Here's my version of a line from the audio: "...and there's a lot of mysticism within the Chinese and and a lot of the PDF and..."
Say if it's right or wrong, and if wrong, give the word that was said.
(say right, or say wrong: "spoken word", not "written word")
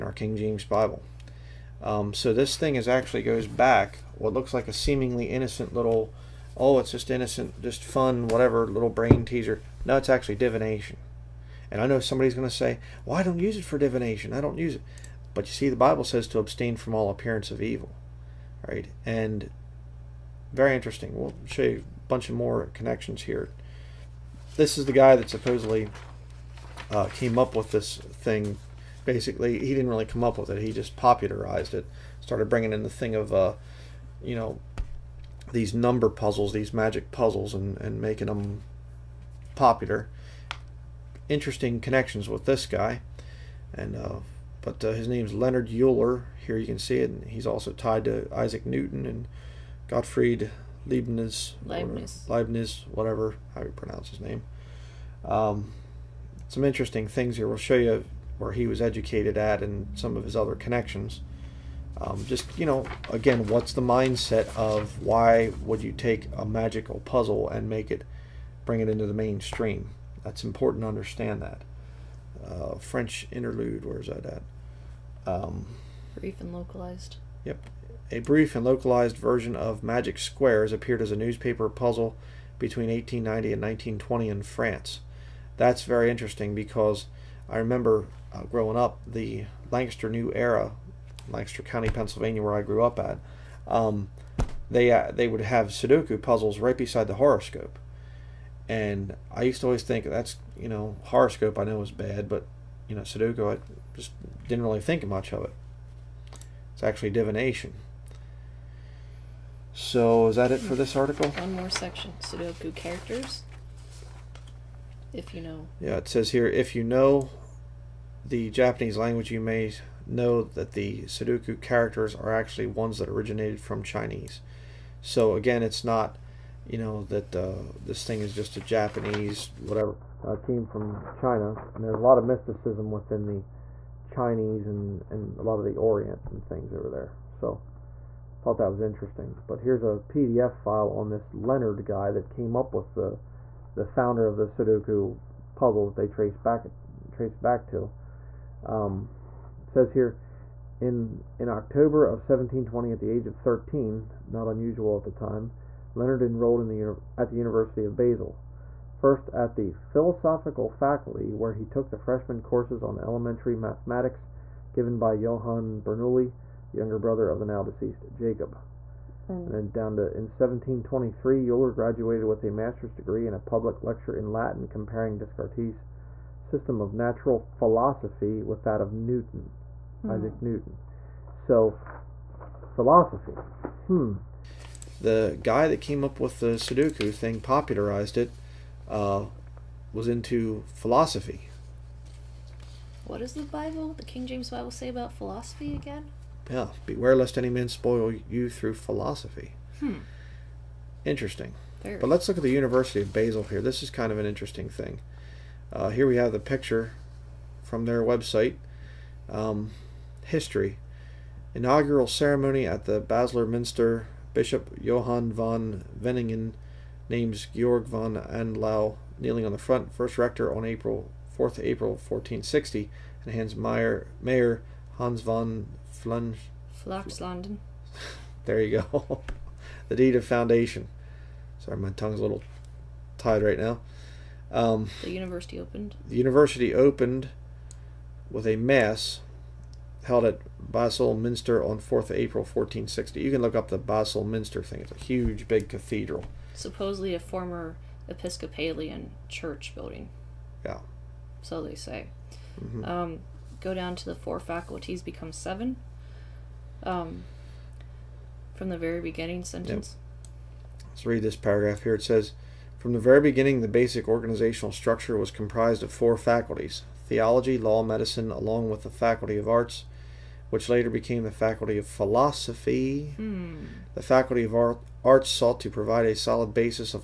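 wrong: "Orient", not "PDF".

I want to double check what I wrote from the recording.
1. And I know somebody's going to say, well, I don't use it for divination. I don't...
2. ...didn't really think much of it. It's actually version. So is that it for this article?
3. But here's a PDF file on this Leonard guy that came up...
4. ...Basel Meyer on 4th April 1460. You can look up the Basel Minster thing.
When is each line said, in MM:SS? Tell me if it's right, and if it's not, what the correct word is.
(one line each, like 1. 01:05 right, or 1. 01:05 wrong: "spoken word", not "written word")
1. 00:11 right
2. 01:44 wrong: "divination", not "version"
3. 02:19 right
4. 04:00 wrong: "Minster", not "Meyer".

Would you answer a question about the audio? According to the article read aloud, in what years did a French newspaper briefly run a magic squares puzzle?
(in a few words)
1890 to 1920.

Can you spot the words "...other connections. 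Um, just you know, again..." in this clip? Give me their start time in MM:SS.
01:00.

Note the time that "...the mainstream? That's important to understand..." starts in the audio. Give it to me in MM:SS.
01:09.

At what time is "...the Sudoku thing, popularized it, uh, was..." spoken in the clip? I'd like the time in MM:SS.
03:06.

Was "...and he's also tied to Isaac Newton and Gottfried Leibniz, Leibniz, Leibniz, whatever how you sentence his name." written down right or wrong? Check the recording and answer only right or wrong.
wrong.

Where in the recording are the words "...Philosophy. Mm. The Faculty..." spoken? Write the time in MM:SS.
04:31.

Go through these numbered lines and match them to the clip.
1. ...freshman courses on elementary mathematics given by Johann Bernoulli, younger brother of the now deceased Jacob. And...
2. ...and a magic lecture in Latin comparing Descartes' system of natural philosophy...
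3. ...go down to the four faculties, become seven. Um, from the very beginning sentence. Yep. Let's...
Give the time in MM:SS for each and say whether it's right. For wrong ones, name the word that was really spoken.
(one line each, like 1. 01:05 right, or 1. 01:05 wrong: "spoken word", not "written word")
1. 02:41 right
2. 02:53 wrong: "public", not "magic"
3. 04:13 right.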